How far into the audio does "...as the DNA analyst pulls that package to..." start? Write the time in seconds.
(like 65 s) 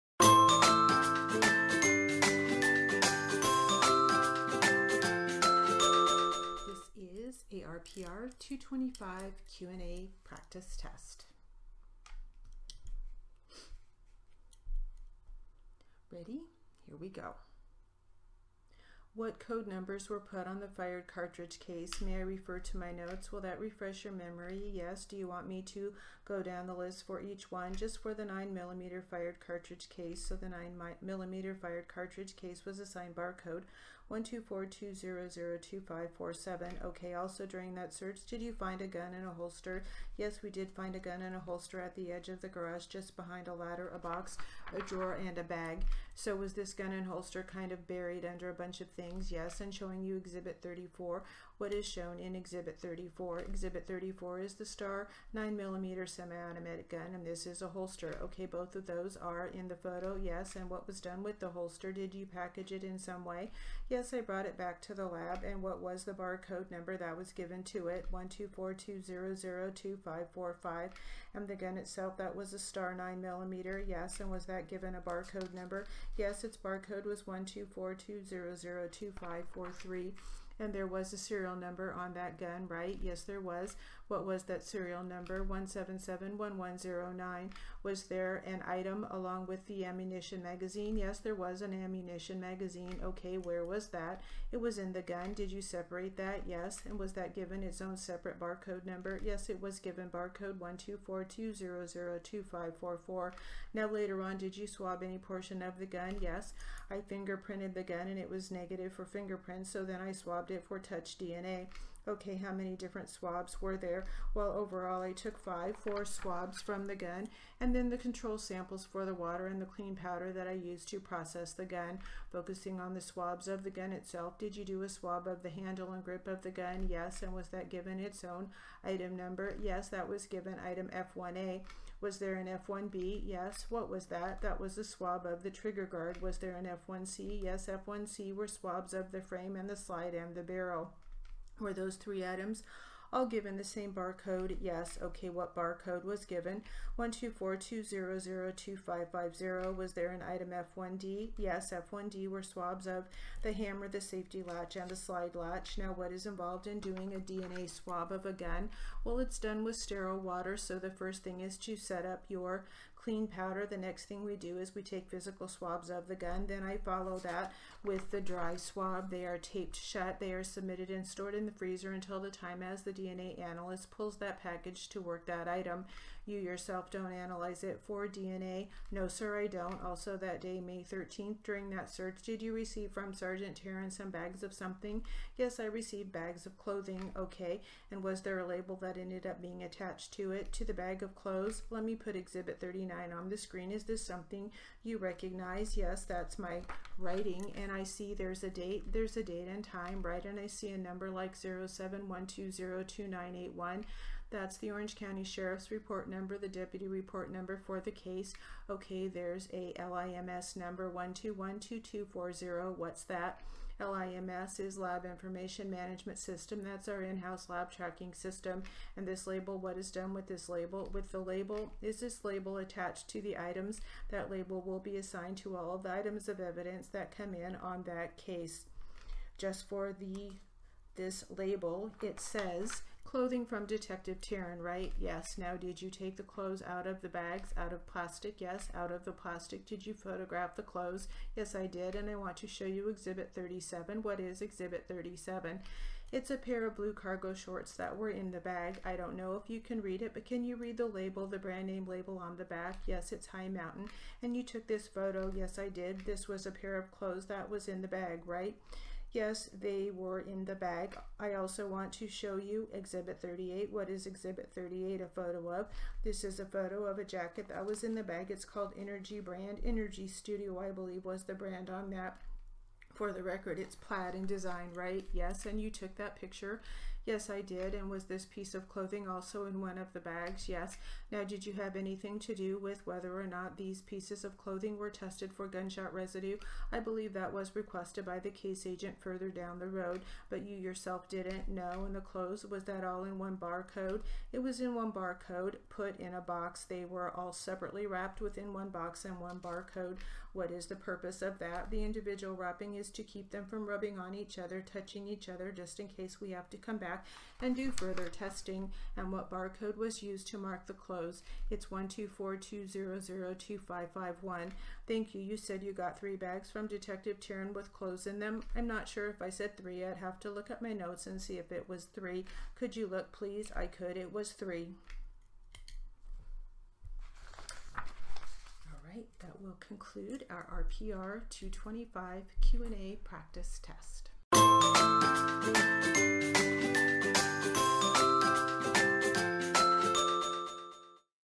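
172 s.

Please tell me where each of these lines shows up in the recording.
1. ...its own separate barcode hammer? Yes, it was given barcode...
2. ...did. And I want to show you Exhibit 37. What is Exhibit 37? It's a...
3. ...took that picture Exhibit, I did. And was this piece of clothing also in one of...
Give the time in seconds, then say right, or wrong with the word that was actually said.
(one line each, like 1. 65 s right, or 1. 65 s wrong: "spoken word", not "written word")
1. 97 s wrong: "number", not "hammer"
2. 241 s right
3. 275 s wrong: "Yes", not "Exhibit".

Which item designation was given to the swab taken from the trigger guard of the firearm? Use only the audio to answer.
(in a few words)
F1B.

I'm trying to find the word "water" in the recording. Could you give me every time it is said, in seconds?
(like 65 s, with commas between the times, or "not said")
119 s, 160 s.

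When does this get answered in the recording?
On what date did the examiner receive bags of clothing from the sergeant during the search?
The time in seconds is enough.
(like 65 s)
180 s.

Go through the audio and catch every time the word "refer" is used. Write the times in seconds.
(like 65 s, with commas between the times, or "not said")
22 s.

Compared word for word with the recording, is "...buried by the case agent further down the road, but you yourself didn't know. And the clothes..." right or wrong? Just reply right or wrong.
wrong.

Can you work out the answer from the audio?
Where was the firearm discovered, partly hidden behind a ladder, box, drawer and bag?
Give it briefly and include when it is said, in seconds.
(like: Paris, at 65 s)
edge of the garage, at 42 s.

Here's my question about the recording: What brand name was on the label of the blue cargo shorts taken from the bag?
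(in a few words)
High Mountain.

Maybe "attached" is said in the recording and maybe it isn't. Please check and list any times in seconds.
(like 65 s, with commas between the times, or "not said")
189 s, 222 s.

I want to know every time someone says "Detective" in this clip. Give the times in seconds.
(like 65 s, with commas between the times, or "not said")
233 s, 316 s.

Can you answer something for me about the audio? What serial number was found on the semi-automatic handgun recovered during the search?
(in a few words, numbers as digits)
1771109.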